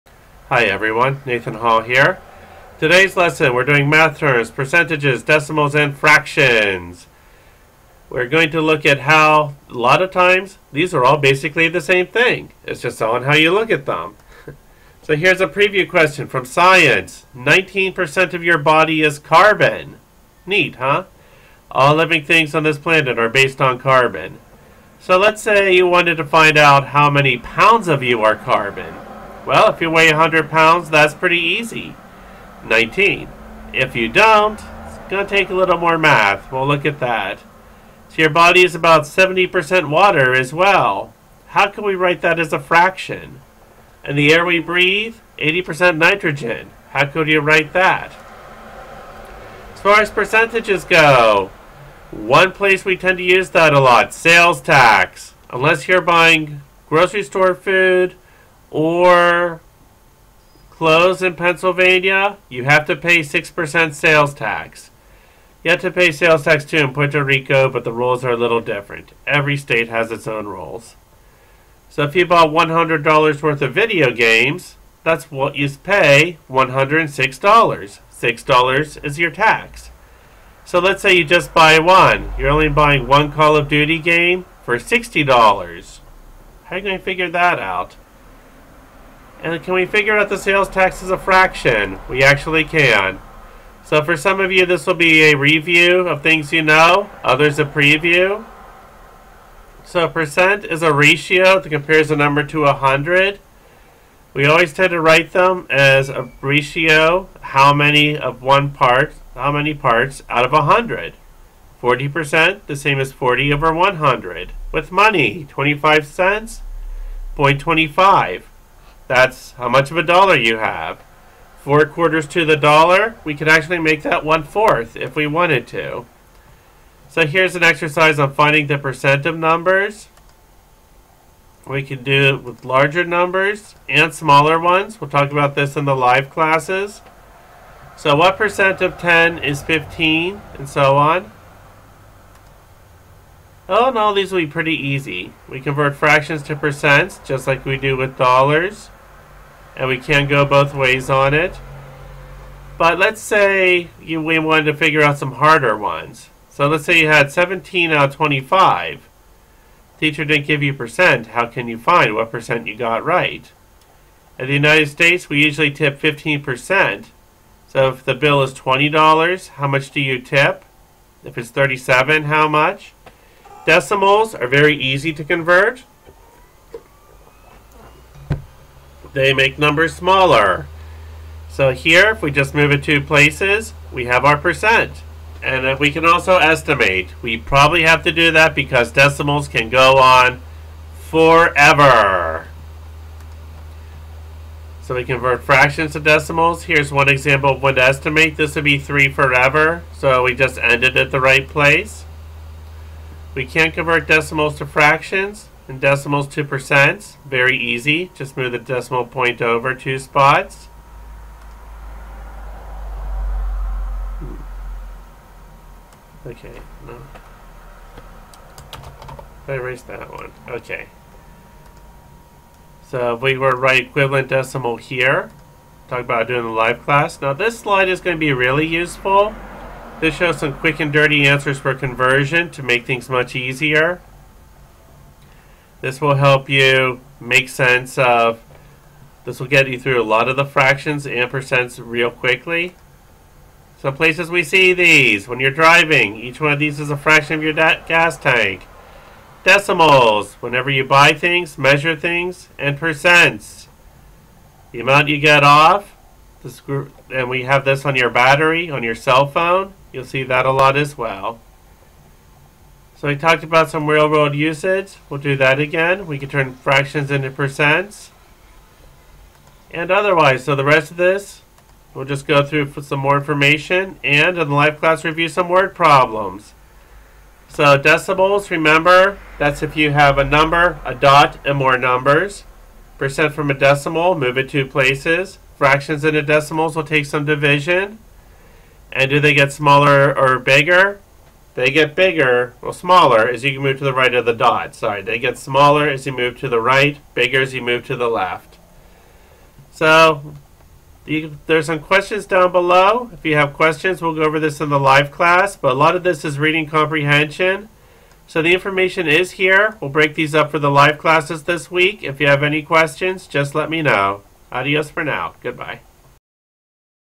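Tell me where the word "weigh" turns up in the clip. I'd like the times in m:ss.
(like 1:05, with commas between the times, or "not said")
0:29.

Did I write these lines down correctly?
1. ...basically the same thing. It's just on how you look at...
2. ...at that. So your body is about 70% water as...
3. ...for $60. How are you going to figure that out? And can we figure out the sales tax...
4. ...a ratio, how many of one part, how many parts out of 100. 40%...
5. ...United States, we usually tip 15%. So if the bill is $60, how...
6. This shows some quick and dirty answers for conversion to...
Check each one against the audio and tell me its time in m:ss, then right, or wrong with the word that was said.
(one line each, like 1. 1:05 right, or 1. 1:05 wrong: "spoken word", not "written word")
1. 0:11 right
2. 0:36 right
3. 1:24 right
4. 1:46 right
5. 2:44 wrong: "20", not "60"
6. 3:50 right.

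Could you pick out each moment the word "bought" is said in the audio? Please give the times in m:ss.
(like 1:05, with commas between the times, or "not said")
1:12.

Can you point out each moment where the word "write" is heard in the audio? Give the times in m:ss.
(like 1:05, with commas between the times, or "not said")
0:41, 0:47, 1:45, 3:43.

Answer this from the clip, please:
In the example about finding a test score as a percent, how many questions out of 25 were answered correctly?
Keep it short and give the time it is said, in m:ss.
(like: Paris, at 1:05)
17, at 2:37.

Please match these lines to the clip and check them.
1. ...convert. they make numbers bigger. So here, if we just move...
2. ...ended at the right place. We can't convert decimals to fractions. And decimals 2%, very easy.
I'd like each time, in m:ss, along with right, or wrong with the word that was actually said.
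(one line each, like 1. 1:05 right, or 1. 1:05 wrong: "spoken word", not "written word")
1. 2:55 wrong: "smaller", not "bigger"
2. 3:20 right.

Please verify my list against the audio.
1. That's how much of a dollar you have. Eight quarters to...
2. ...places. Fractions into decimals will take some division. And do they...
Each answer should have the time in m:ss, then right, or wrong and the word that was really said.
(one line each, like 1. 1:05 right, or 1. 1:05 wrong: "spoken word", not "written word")
1. 1:59 wrong: "Four", not "Eight"
2. 4:44 right.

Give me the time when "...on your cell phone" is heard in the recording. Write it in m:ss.
4:18.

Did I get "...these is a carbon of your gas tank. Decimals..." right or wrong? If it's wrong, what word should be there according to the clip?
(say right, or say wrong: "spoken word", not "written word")
wrong: "fraction", not "carbon".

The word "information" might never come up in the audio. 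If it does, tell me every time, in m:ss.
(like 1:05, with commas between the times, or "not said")
4:33, 5:08.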